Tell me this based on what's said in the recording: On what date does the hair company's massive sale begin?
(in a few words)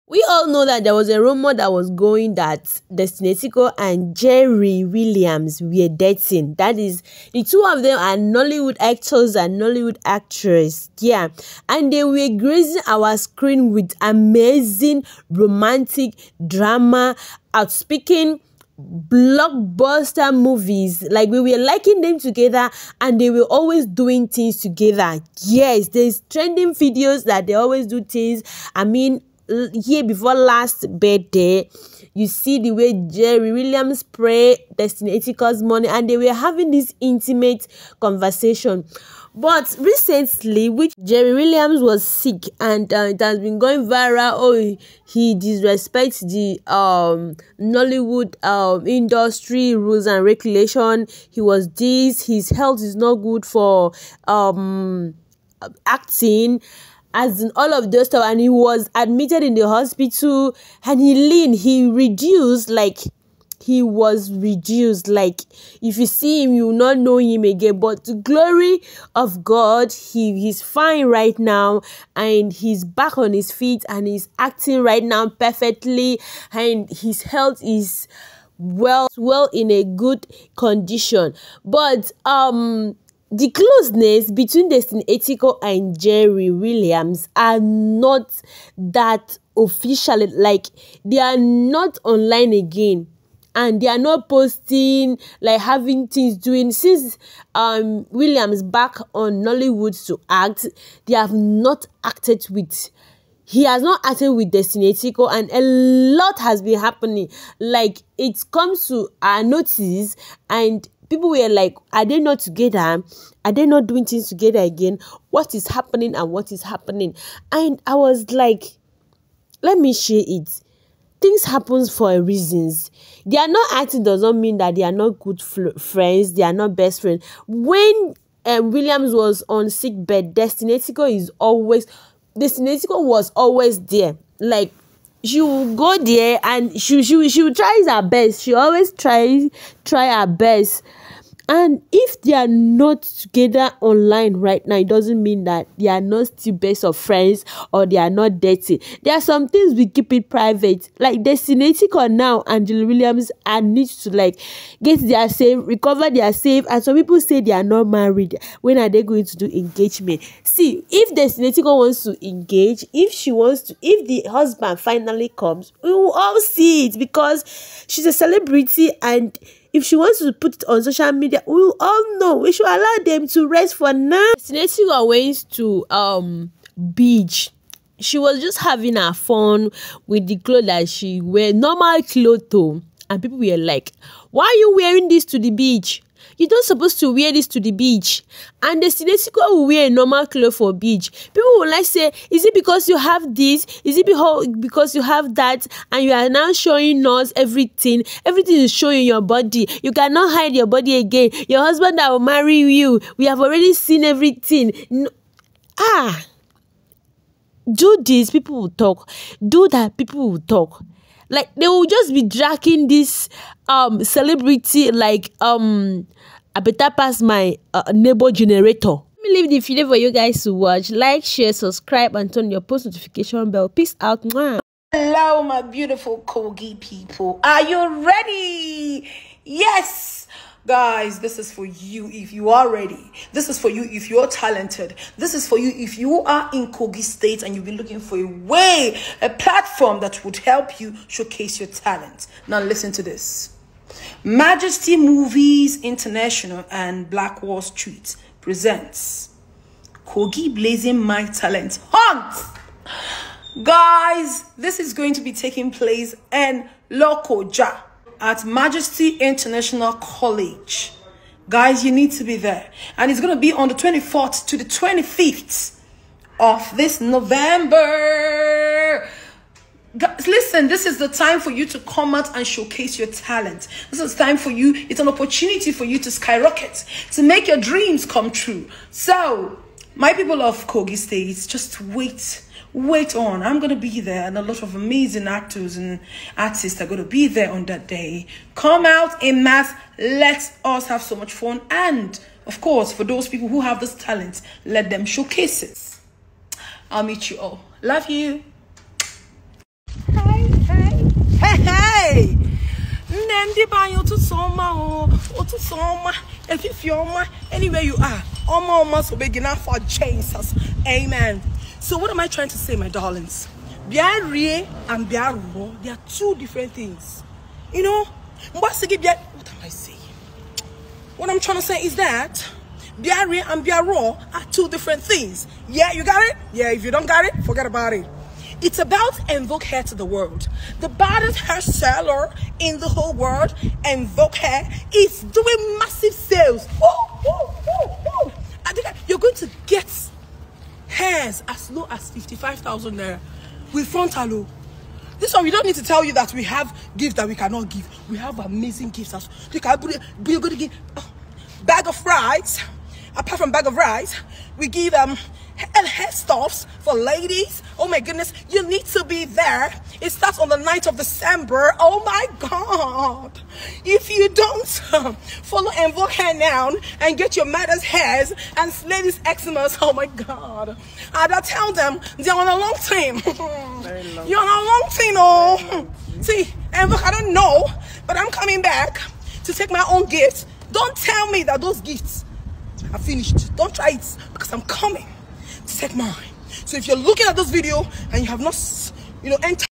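9th of December.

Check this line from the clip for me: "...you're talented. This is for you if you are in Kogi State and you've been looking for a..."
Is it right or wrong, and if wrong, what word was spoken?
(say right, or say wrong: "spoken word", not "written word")
right.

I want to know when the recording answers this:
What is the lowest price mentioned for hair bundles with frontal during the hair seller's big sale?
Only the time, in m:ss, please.
5:42.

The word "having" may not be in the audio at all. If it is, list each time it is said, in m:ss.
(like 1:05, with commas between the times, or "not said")
0:36, 1:35, 2:58.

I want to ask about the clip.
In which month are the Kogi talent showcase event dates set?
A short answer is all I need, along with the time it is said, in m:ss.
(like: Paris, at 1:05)
November, at 4:27.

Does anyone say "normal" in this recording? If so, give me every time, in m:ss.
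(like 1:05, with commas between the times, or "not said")
3:01, 3:09.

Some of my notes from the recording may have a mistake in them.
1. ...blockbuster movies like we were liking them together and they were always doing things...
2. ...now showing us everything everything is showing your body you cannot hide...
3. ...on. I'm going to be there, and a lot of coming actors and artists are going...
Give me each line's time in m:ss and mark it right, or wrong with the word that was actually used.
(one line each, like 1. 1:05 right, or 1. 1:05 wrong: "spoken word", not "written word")
1. 0:18 right
2. 3:16 right
3. 4:43 wrong: "amazing", not "coming".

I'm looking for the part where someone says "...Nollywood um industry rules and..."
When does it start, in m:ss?
0:47.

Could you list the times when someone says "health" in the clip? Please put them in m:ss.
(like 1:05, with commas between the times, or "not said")
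0:52, 1:17.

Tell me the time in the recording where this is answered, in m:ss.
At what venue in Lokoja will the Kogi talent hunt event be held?
4:18.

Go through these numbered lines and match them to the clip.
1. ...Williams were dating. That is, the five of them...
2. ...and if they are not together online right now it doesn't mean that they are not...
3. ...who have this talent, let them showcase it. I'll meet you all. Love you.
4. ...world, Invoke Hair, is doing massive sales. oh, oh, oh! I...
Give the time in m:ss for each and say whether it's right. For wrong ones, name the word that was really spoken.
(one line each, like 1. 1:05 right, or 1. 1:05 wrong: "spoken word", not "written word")
1. 0:04 wrong: "two", not "five"
2. 2:21 right
3. 4:53 right
4. 5:33 right.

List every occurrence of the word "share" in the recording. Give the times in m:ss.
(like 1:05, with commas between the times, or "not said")
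1:59, 3:41.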